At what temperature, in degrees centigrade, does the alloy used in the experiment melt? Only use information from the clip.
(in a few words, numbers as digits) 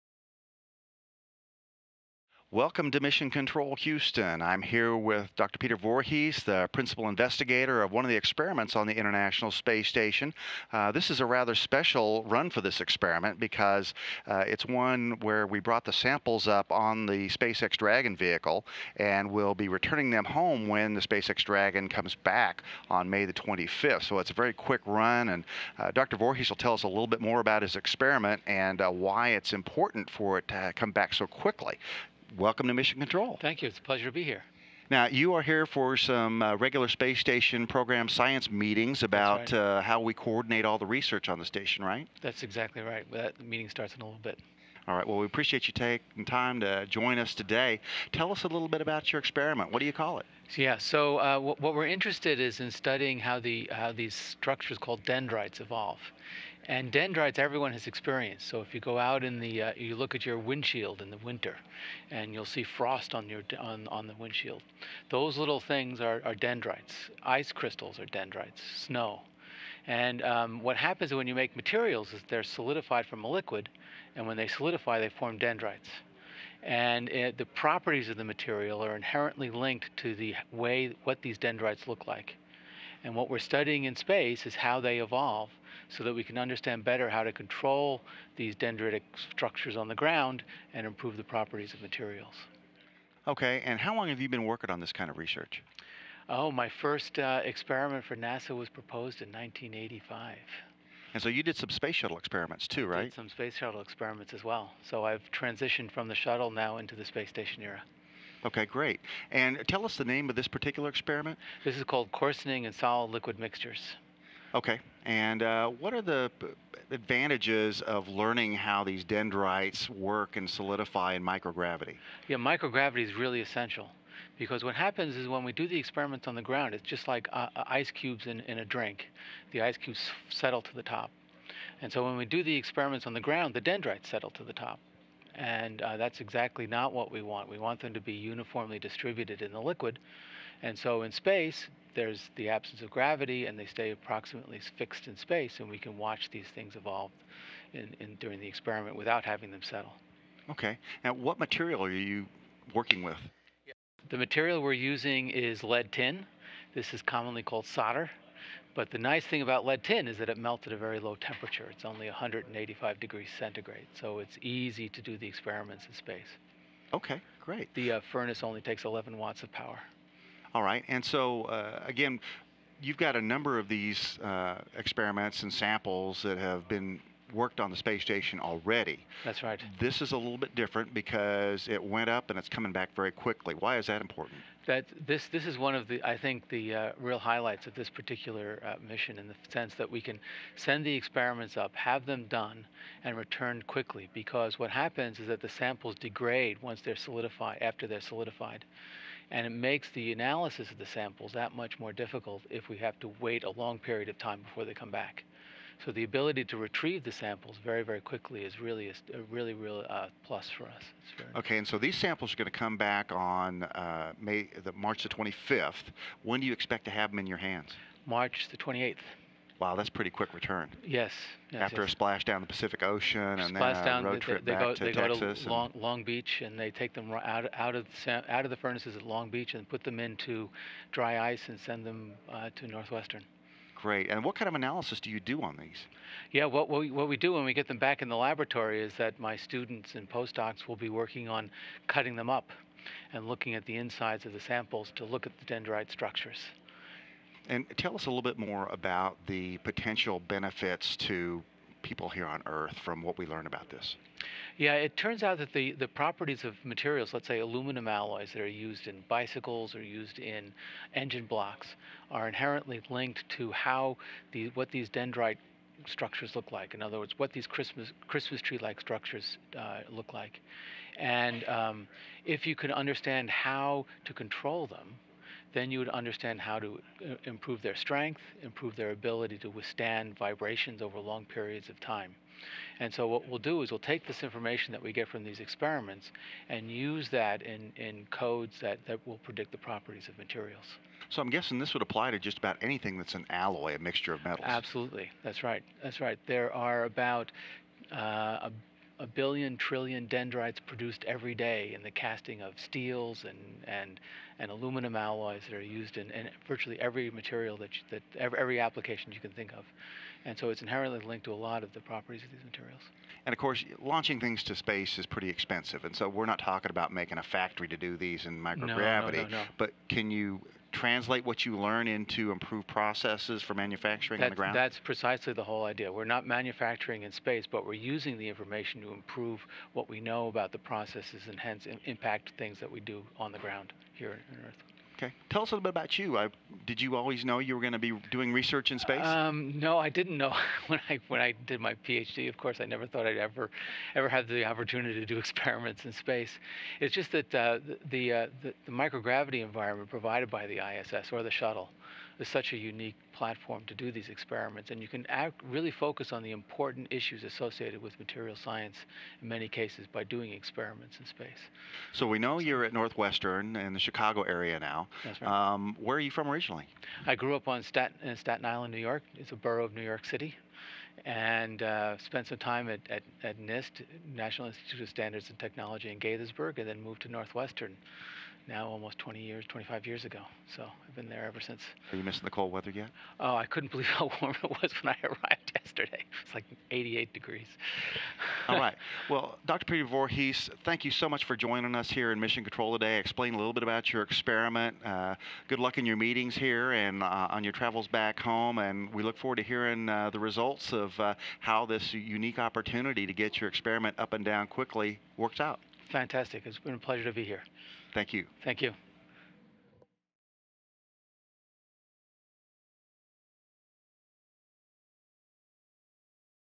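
185.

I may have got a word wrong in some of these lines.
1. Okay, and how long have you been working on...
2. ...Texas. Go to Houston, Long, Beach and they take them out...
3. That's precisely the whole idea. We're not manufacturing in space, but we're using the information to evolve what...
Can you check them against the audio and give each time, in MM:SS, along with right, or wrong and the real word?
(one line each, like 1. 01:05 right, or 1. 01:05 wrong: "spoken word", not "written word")
1. 01:33 right
2. 03:44 wrong: "Long", not "Houston"
3. 05:24 wrong: "improve", not "evolve".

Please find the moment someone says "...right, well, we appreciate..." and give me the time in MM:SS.
00:44.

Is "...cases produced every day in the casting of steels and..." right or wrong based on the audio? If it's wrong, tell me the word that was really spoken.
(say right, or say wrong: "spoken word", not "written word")
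wrong: "dendrites", not "cases".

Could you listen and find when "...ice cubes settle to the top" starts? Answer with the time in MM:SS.
02:09.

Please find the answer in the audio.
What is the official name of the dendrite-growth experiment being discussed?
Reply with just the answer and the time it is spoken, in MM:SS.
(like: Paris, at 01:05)
Coarsening in solid liquid mixtures, at 01:52.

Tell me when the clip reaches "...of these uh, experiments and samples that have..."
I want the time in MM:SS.
02:53.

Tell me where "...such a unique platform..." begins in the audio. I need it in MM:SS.
05:52.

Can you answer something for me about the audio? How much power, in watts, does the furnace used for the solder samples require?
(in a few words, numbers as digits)
11 watts.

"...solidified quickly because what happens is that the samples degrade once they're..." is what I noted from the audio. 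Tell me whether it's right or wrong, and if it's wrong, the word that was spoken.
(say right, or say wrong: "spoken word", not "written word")
wrong: "returned", not "solidified".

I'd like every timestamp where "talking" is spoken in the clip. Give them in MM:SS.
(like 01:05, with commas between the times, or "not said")
05:16.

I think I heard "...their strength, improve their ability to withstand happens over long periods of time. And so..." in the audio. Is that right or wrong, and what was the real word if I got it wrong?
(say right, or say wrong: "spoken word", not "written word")
wrong: "vibrations", not "happens".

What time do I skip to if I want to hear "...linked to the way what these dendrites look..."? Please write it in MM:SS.
01:19.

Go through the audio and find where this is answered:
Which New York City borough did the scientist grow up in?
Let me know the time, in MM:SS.
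06:08.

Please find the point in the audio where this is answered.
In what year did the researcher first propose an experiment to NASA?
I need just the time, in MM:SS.
01:39.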